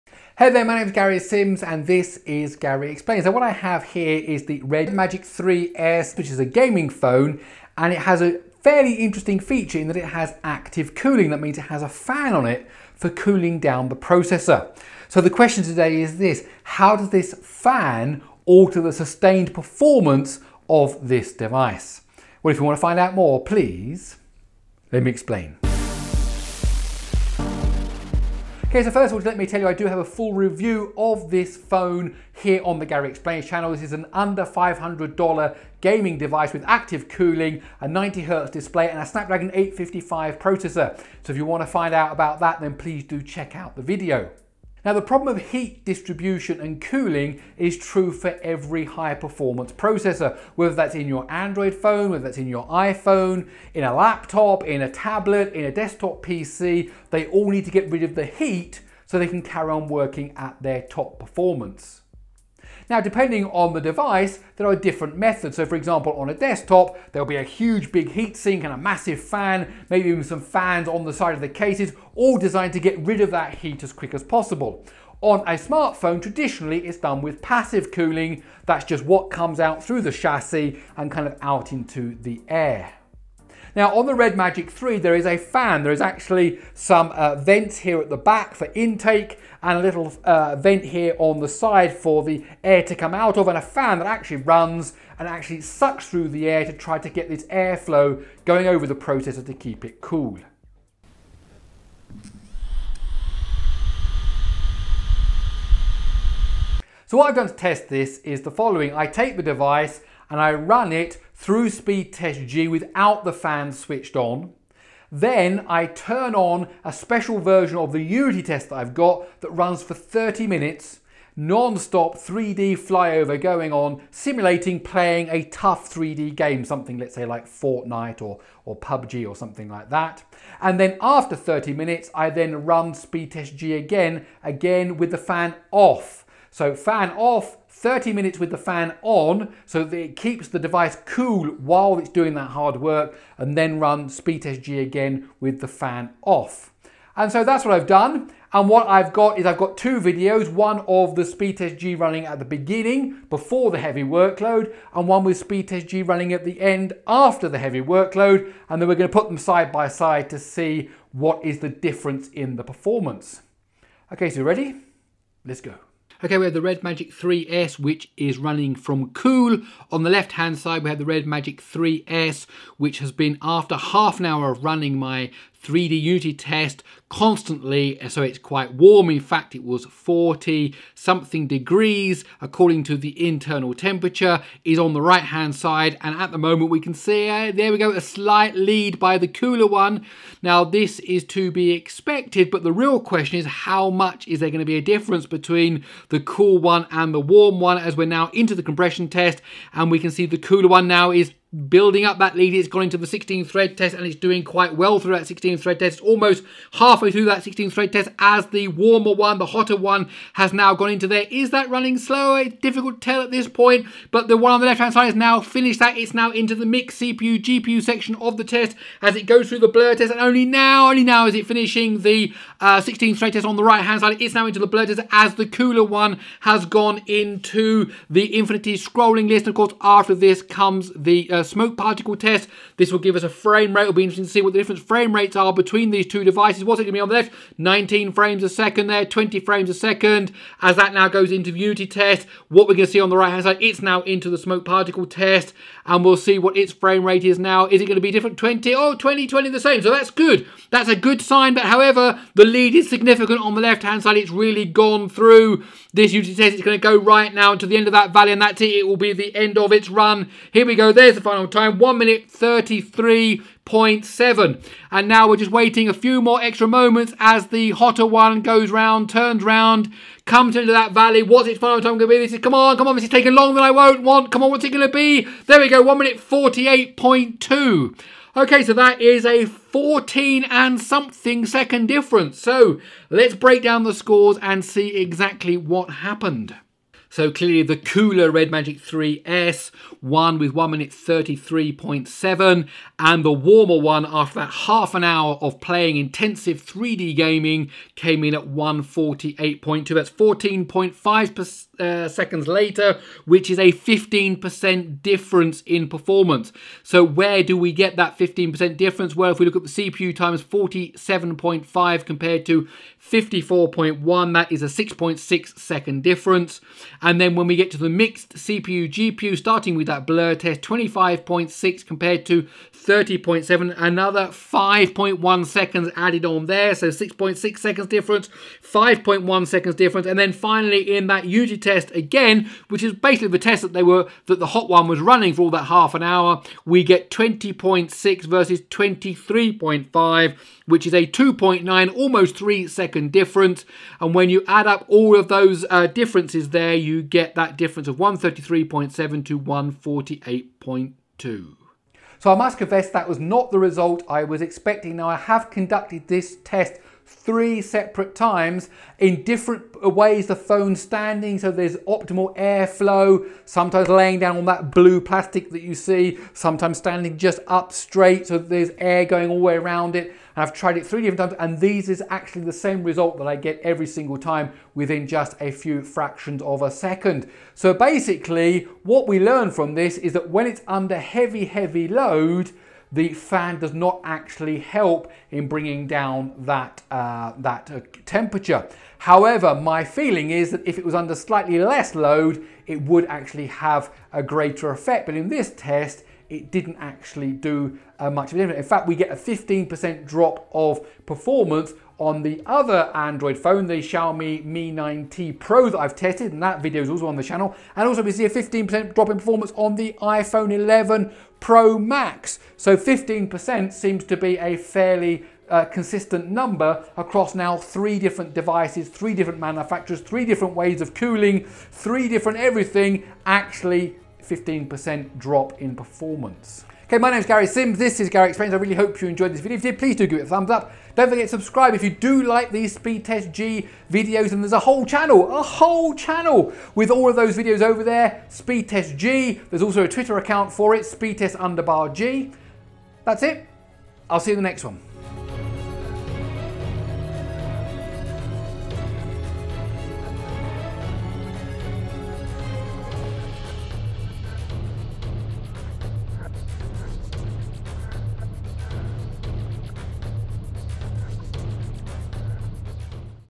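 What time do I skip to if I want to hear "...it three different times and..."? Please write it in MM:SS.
06:10.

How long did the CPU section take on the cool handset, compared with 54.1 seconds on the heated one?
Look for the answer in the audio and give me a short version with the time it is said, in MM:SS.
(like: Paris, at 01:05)
47.5 seconds, at 05:10.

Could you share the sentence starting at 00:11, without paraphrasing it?
That means it has a fan on it for cooling down the processor.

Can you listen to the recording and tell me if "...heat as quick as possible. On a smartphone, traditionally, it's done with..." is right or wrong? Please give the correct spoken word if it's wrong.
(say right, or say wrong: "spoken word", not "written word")
right.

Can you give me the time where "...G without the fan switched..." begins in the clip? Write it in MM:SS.
01:52.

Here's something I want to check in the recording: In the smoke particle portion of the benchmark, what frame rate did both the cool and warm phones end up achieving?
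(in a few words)
20 frames per second.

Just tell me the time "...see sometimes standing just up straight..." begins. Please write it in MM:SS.
06:05.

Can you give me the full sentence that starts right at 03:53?
It'll be interesting to see what the different frame rates are between these two devices.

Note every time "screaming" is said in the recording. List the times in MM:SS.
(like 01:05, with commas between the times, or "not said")
not said.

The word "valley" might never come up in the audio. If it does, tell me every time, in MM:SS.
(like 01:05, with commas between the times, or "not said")
04:18, 04:30.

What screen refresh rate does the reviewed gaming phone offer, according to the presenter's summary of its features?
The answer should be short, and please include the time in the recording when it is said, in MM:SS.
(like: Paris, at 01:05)
90 hertz, at 00:37.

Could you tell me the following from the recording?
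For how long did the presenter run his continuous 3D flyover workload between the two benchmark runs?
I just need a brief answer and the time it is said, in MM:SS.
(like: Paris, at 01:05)
30 minutes, at 01:59.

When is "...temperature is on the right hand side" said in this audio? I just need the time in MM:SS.
03:03.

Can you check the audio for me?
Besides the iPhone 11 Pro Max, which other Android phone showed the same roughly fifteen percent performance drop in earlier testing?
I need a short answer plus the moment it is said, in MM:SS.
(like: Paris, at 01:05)
Xiaomi Mi 9T Pro, at 06:43.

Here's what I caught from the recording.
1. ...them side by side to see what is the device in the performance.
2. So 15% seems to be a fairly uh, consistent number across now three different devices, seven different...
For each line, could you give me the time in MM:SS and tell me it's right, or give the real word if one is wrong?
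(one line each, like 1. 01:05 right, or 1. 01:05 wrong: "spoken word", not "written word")
1. 02:39 wrong: "difference", not "device"
2. 06:52 wrong: "three", not "seven".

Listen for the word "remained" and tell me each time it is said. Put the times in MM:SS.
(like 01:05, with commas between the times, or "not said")
not said.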